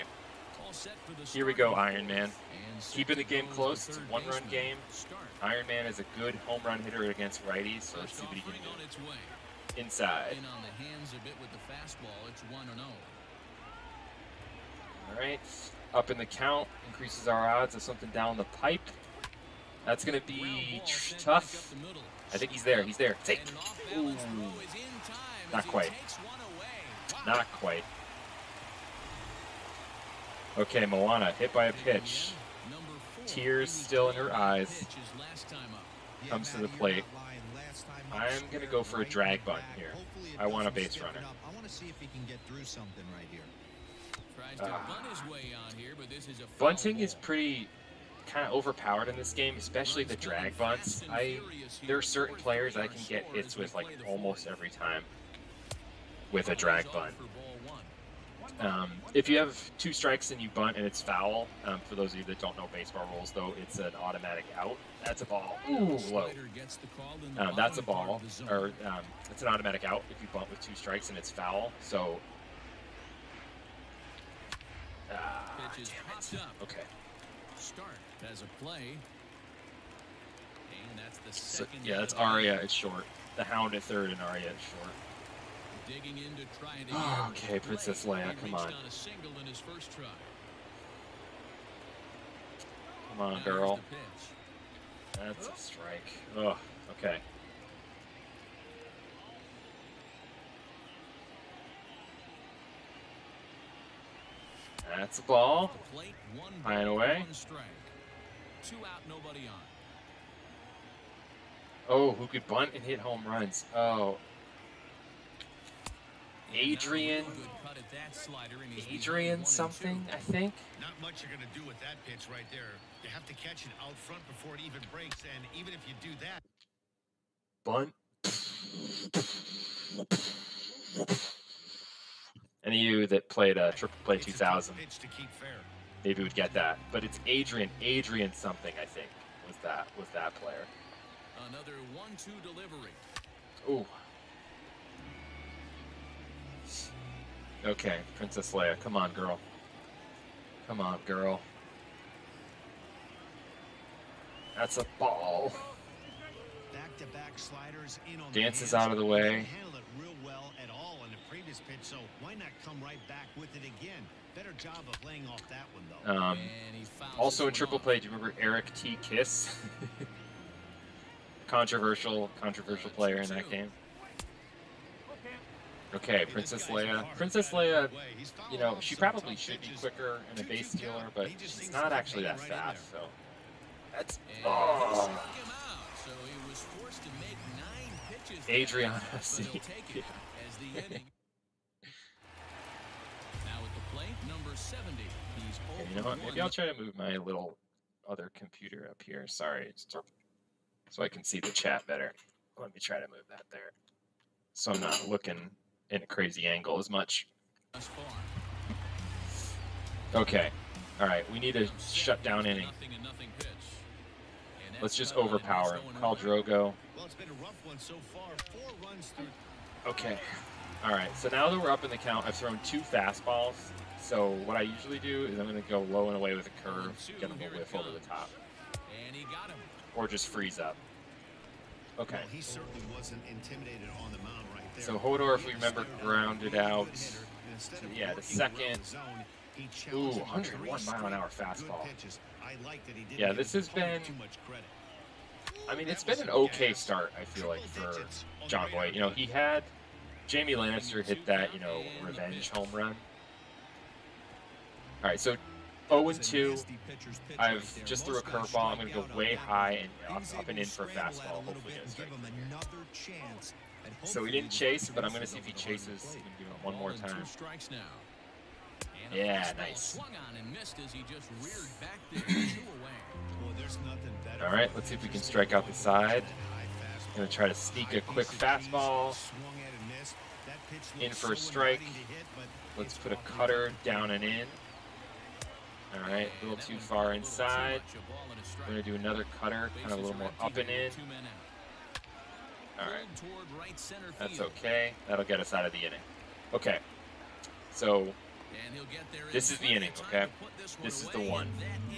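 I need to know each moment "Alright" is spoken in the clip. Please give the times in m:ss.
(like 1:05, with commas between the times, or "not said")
3:30, 3:40, 4:52.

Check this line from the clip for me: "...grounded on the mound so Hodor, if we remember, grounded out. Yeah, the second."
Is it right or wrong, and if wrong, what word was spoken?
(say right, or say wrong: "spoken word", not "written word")
wrong: "intimidated", not "grounded".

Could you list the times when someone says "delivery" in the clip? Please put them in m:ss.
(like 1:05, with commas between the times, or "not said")
2:22.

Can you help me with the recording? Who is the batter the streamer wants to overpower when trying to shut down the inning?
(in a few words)
Khal Drogo.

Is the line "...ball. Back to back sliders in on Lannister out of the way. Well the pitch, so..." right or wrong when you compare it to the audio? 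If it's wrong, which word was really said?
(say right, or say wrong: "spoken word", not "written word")
wrong: "Dances", not "Lannister".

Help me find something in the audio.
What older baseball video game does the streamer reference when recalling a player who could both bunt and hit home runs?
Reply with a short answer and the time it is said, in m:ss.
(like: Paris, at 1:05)
Triple Play 2000, at 2:13.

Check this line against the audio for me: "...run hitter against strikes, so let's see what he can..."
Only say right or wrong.
wrong.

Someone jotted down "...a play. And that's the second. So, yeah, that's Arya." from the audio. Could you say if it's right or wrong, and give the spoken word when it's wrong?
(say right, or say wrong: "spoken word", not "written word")
right.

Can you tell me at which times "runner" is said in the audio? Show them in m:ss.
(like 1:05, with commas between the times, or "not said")
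0:40.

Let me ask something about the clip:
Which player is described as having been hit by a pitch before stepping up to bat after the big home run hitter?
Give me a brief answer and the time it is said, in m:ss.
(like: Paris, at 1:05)
Moana, at 0:30.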